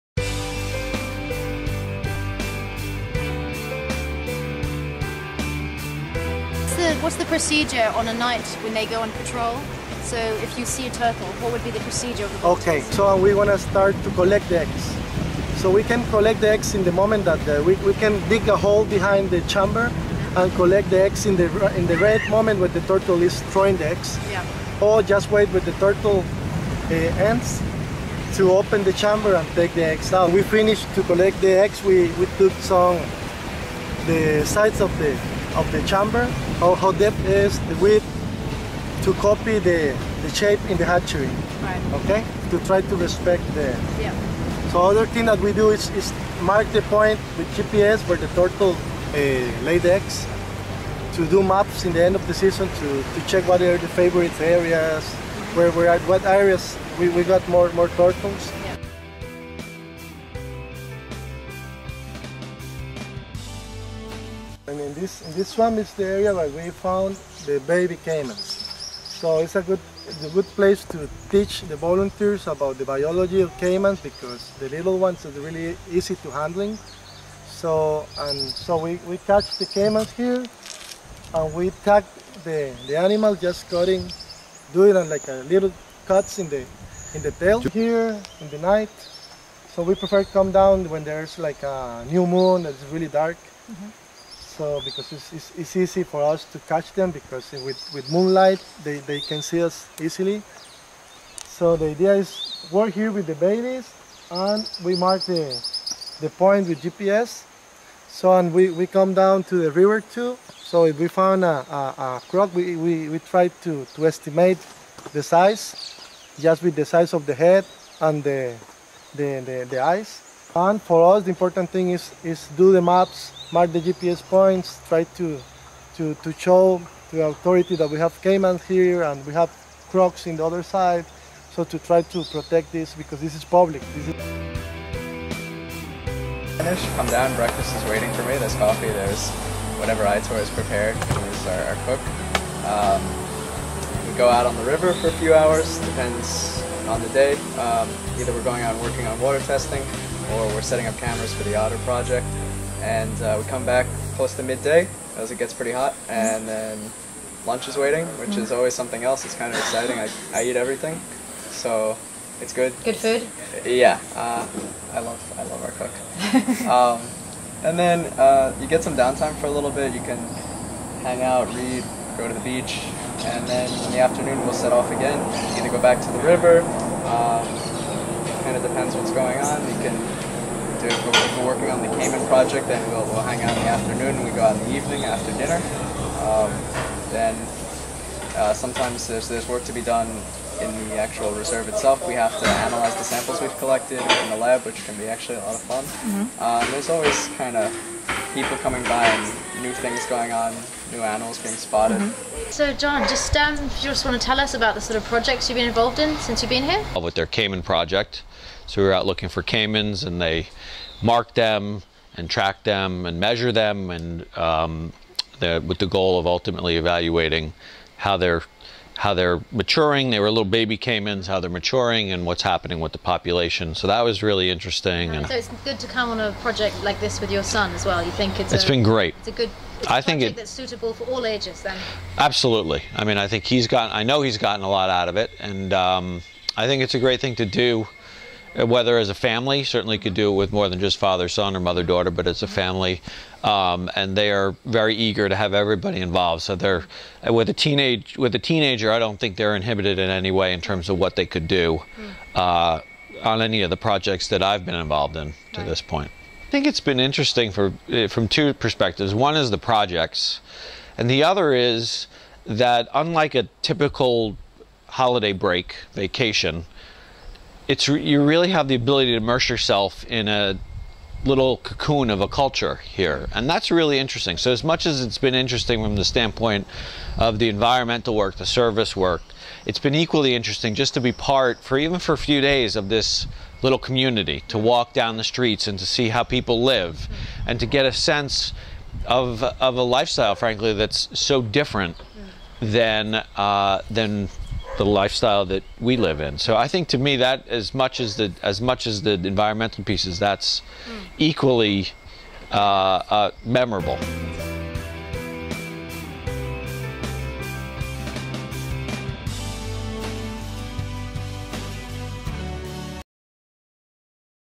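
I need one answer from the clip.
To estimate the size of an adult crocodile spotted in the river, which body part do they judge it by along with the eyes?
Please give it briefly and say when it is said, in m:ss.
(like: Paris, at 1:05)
The head, at 1:56.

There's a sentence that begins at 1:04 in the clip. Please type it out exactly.
And in this, in this swamp is the area where we found the baby caimans.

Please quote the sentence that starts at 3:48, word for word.
You think it's it's a, been great.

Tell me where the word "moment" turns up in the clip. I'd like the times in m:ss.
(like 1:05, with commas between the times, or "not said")
0:16, 0:22.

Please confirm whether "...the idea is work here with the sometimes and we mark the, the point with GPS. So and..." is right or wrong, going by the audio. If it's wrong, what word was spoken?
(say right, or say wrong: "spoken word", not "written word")
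wrong: "babies", not "sometimes".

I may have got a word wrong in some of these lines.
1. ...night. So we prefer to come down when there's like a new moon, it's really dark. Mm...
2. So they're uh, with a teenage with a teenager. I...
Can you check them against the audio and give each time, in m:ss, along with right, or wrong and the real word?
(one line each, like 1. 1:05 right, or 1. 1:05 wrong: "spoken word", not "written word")
1. 1:28 right
2. 4:06 right.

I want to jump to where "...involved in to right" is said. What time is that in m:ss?
4:14.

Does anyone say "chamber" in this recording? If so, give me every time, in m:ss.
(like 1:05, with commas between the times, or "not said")
0:19, 0:28, 0:35.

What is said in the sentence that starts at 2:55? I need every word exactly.
Either go back to the river.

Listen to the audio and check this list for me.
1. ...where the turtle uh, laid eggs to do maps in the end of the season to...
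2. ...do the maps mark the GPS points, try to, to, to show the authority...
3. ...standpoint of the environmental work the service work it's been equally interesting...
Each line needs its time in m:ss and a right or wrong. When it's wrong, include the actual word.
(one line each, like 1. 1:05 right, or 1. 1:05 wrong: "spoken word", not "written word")
1. 0:48 right
2. 2:02 right
3. 4:36 right.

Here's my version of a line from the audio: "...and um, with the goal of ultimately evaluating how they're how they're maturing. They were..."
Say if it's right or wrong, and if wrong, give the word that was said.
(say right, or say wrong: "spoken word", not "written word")
right.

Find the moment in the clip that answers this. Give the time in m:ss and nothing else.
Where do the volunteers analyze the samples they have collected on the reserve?
3:14.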